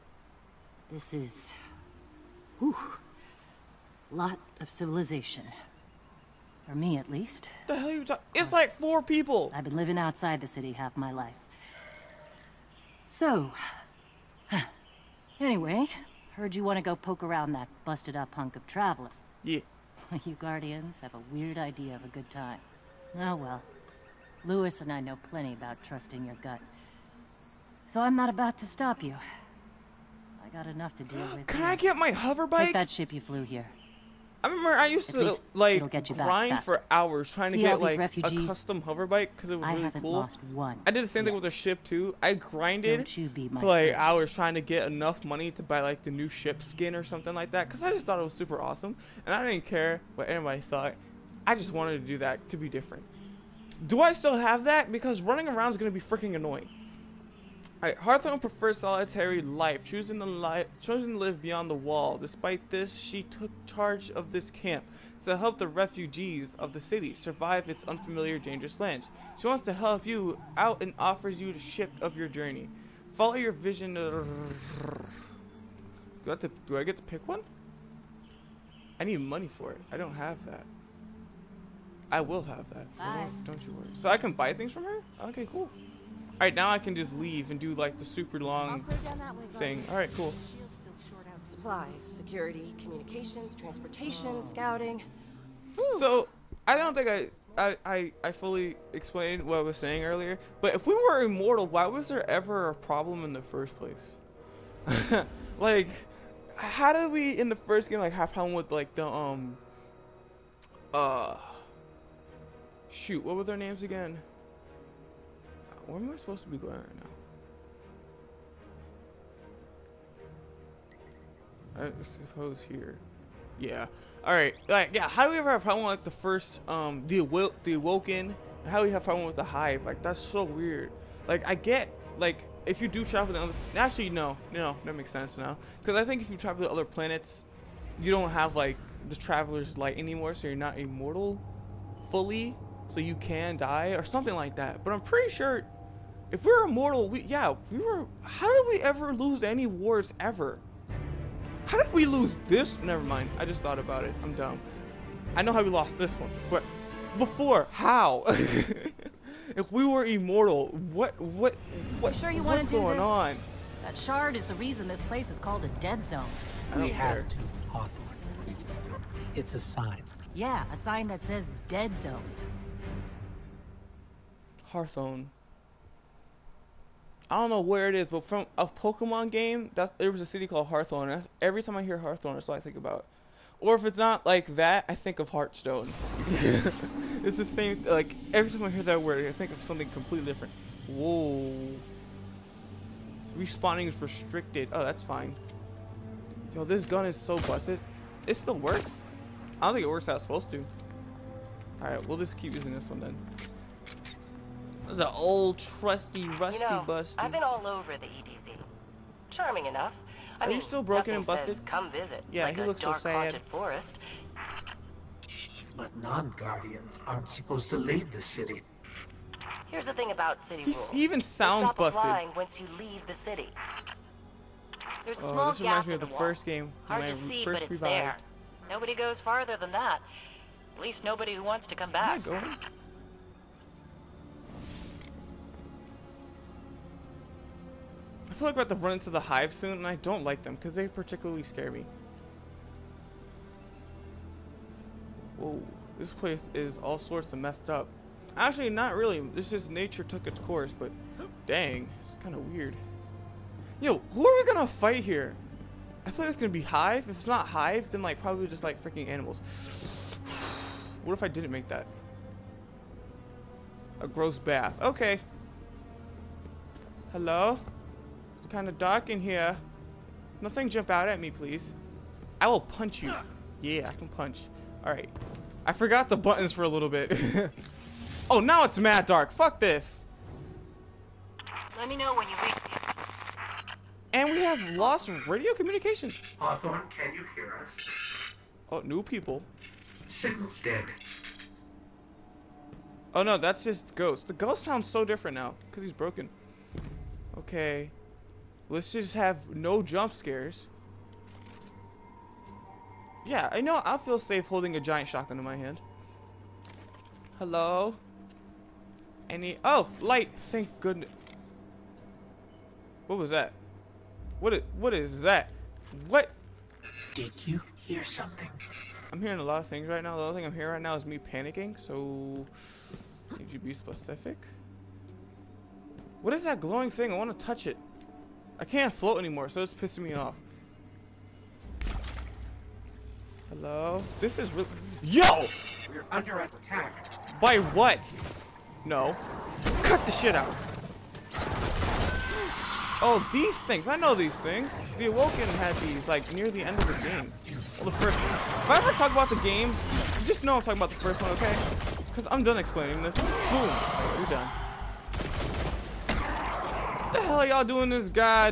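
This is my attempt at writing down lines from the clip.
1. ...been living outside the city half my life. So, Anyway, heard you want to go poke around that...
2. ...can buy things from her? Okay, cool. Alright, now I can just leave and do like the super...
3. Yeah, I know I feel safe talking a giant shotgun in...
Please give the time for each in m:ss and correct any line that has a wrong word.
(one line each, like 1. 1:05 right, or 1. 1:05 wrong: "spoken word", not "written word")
1. 0:09 right
2. 1:24 right
3. 5:03 wrong: "holding", not "talking".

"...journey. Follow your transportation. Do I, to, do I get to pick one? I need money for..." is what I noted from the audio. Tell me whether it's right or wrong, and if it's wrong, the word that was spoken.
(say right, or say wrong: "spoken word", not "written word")
wrong: "vision", not "transportation".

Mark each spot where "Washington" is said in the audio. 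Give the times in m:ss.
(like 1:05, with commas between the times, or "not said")
not said.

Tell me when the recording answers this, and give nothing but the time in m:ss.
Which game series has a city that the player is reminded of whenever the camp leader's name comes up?
2:58.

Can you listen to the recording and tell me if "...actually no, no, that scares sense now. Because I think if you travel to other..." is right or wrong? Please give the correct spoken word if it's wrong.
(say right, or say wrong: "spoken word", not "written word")
wrong: "makes", not "scares".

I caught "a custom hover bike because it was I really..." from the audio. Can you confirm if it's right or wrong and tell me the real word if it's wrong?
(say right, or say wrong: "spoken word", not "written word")
right.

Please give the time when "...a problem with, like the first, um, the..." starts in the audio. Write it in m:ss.
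2:05.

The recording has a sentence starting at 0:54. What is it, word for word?
Because running around is going to be freaking annoying.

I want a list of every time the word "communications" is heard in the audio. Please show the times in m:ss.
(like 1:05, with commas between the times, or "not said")
1:32, 4:45.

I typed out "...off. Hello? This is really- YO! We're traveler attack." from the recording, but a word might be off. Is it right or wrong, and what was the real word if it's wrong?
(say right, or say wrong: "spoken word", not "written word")
wrong: "under", not "traveler".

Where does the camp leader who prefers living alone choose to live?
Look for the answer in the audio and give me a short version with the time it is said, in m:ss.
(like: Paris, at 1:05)
beyond the wall, at 1:01.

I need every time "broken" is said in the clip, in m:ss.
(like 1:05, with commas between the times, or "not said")
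3:30, 4:55.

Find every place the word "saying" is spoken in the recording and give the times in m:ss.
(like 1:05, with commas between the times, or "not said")
1:39.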